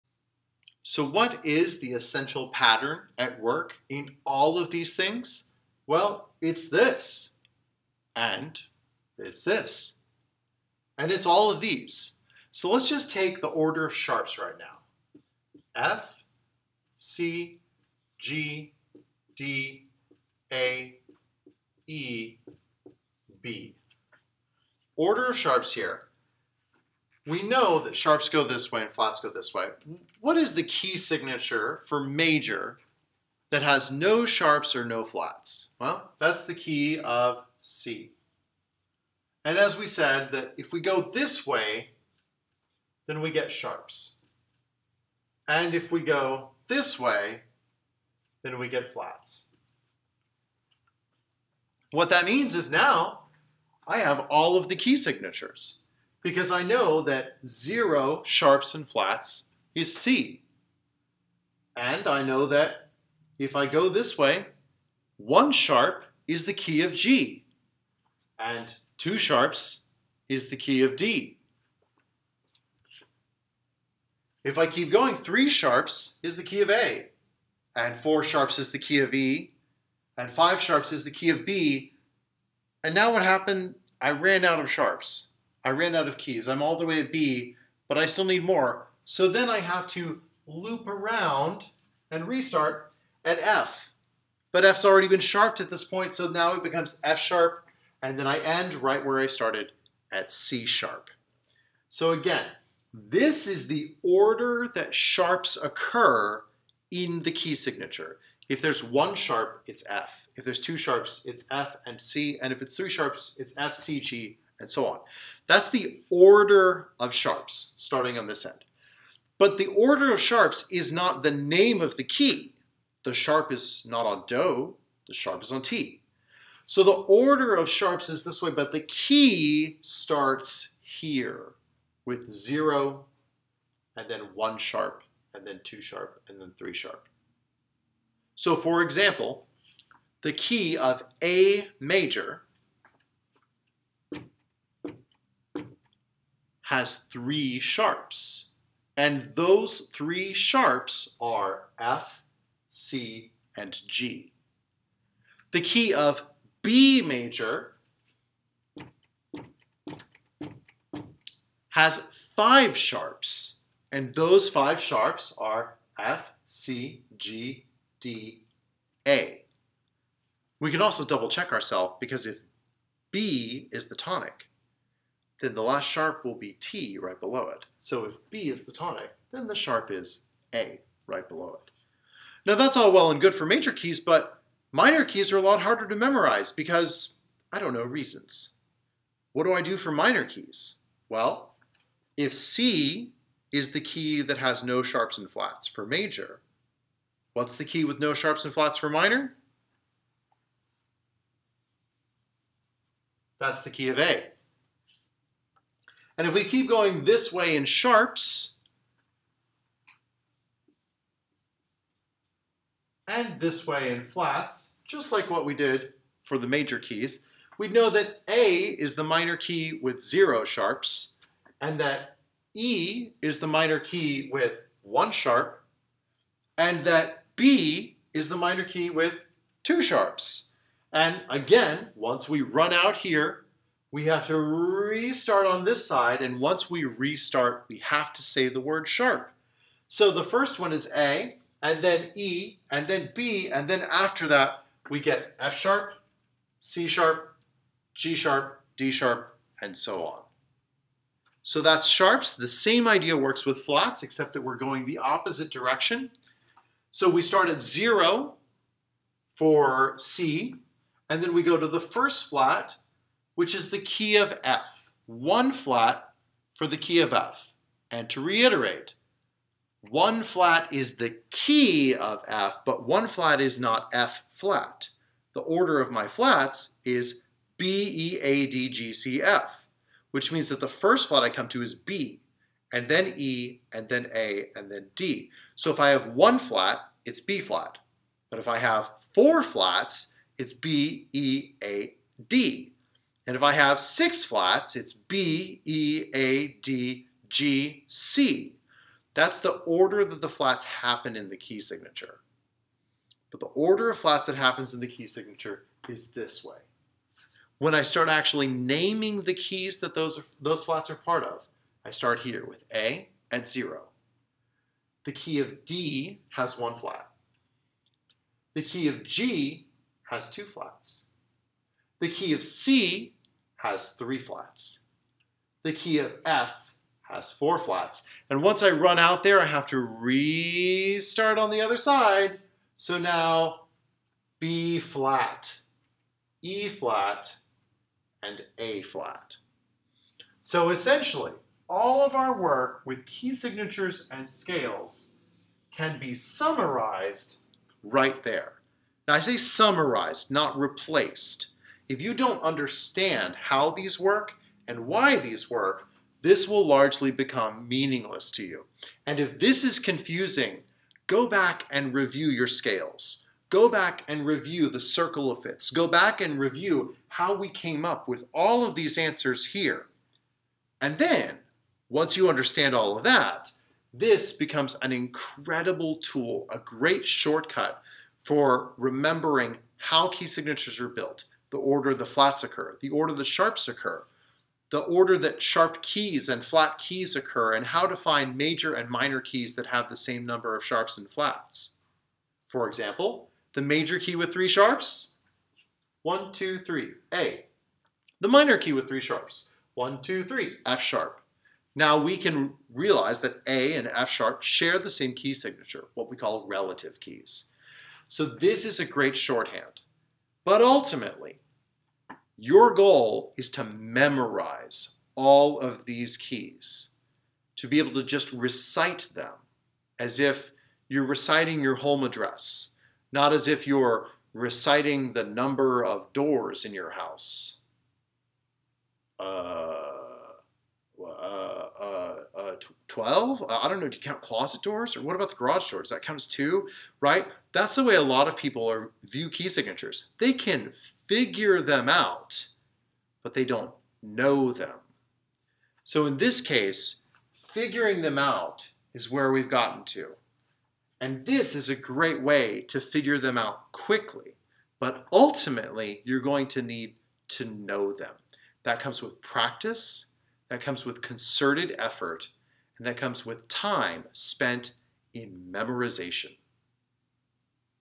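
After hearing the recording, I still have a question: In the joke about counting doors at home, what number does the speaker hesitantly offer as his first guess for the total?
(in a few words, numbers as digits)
12.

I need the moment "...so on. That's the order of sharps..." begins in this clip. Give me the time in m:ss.
1:54.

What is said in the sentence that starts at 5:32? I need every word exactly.
So now B flat, E flat, and A flat.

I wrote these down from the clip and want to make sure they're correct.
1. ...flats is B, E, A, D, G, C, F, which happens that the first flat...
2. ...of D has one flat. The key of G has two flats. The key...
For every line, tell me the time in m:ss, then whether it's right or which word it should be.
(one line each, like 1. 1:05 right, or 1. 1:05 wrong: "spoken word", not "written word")
1. 4:36 wrong: "means", not "happens"
2. 5:15 right.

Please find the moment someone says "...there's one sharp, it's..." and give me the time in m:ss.
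1:48.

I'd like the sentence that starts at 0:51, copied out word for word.
What that means is now I have all of the key signatures because I know that 0 sharps and flats is C.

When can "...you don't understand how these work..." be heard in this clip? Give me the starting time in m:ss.
5:52.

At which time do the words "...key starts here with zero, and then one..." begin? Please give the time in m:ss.
2:08.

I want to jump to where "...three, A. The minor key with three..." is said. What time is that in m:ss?
6:36.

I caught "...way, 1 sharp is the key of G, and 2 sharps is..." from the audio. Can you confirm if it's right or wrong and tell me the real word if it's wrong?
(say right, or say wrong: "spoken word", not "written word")
right.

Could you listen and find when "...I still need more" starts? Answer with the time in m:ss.
1:27.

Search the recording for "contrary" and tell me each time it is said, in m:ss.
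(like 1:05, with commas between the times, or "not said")
not said.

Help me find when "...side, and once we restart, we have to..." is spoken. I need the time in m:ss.
3:55.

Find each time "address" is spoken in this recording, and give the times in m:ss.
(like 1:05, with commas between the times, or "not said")
7:02.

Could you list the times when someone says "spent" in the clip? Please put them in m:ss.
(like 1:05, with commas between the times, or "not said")
7:44.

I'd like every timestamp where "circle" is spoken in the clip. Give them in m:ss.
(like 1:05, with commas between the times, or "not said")
6:04.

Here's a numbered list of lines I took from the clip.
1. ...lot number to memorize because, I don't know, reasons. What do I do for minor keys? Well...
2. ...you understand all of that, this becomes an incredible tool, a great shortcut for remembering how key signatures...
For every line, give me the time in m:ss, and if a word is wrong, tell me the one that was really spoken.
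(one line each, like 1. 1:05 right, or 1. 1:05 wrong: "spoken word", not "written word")
1. 3:05 wrong: "harder", not "number"
2. 6:12 right.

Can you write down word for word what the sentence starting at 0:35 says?
Well, that's the key of C.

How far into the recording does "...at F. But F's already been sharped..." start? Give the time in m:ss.
1:33.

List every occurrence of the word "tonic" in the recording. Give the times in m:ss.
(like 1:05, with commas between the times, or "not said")
2:53, 2:58.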